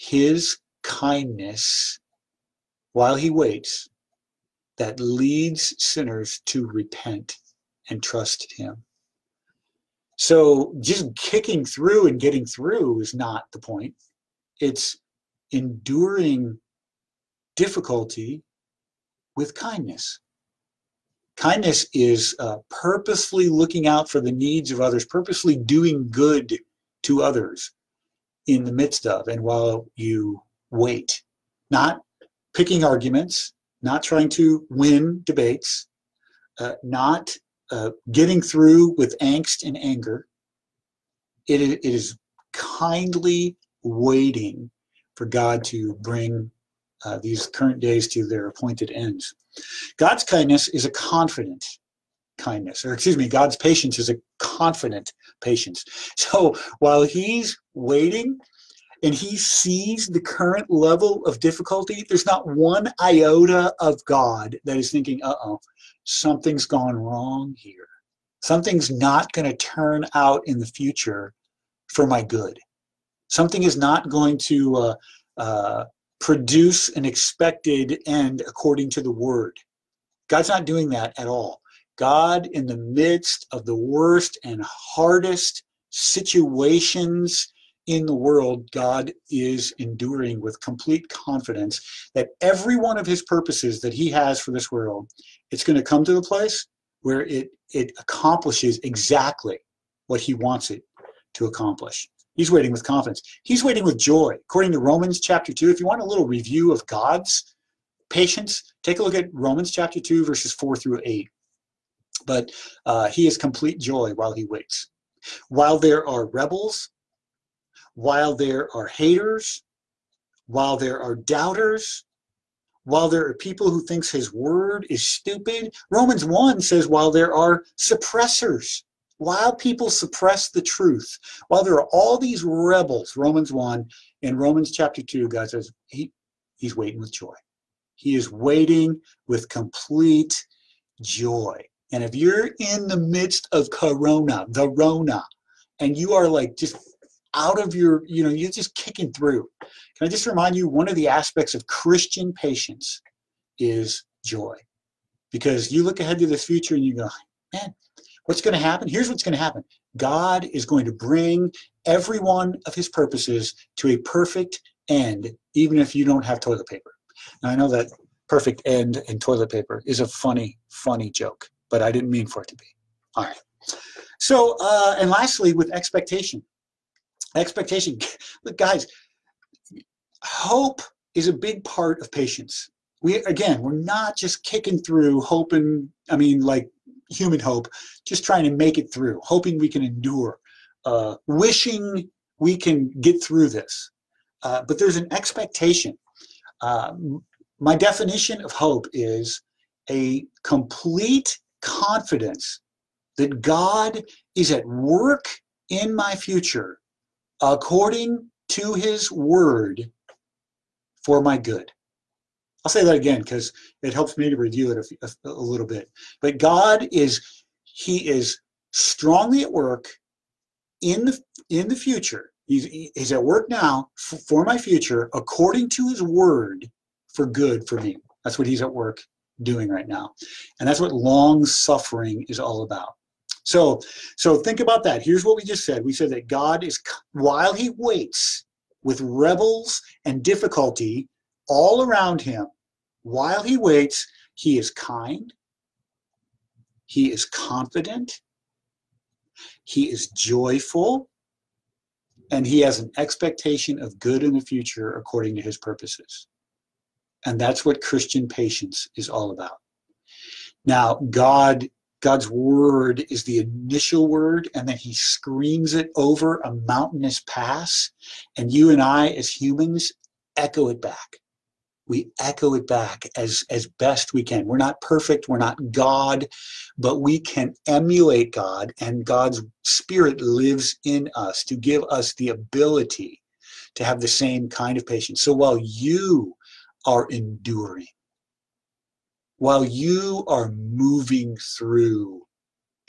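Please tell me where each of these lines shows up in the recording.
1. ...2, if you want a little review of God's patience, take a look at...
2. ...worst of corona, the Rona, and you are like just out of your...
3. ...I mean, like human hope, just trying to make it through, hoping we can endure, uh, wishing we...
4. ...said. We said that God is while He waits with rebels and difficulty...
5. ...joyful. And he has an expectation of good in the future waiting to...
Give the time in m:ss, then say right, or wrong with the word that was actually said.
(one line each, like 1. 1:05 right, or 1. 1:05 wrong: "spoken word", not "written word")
1. 1:45 right
2. 2:22 wrong: "midst", not "worst"
3. 3:06 right
4. 3:55 right
5. 4:10 wrong: "according", not "waiting".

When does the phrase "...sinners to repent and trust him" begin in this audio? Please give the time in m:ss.
0:05.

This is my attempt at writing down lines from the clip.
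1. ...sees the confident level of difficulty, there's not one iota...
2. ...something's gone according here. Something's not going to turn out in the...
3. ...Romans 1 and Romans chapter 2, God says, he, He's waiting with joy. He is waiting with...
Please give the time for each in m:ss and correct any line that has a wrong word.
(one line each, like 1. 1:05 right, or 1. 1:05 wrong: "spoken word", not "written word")
1. 0:59 wrong: "current", not "confident"
2. 1:06 wrong: "wrong", not "according"
3. 2:13 right.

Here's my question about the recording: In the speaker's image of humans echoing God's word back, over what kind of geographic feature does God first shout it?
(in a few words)
A mountainous pass.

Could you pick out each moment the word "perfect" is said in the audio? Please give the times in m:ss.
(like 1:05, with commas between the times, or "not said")
2:43, 2:48, 4:34.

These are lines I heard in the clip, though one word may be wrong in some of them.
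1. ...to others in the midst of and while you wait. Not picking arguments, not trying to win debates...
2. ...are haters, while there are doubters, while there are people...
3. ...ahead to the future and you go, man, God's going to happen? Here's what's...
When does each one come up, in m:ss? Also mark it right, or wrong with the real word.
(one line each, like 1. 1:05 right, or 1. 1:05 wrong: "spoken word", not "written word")
1. 0:27 right
2. 1:58 right
3. 2:35 wrong: "What", not "God".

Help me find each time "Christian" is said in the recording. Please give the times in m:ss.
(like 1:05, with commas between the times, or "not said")
2:31, 4:17.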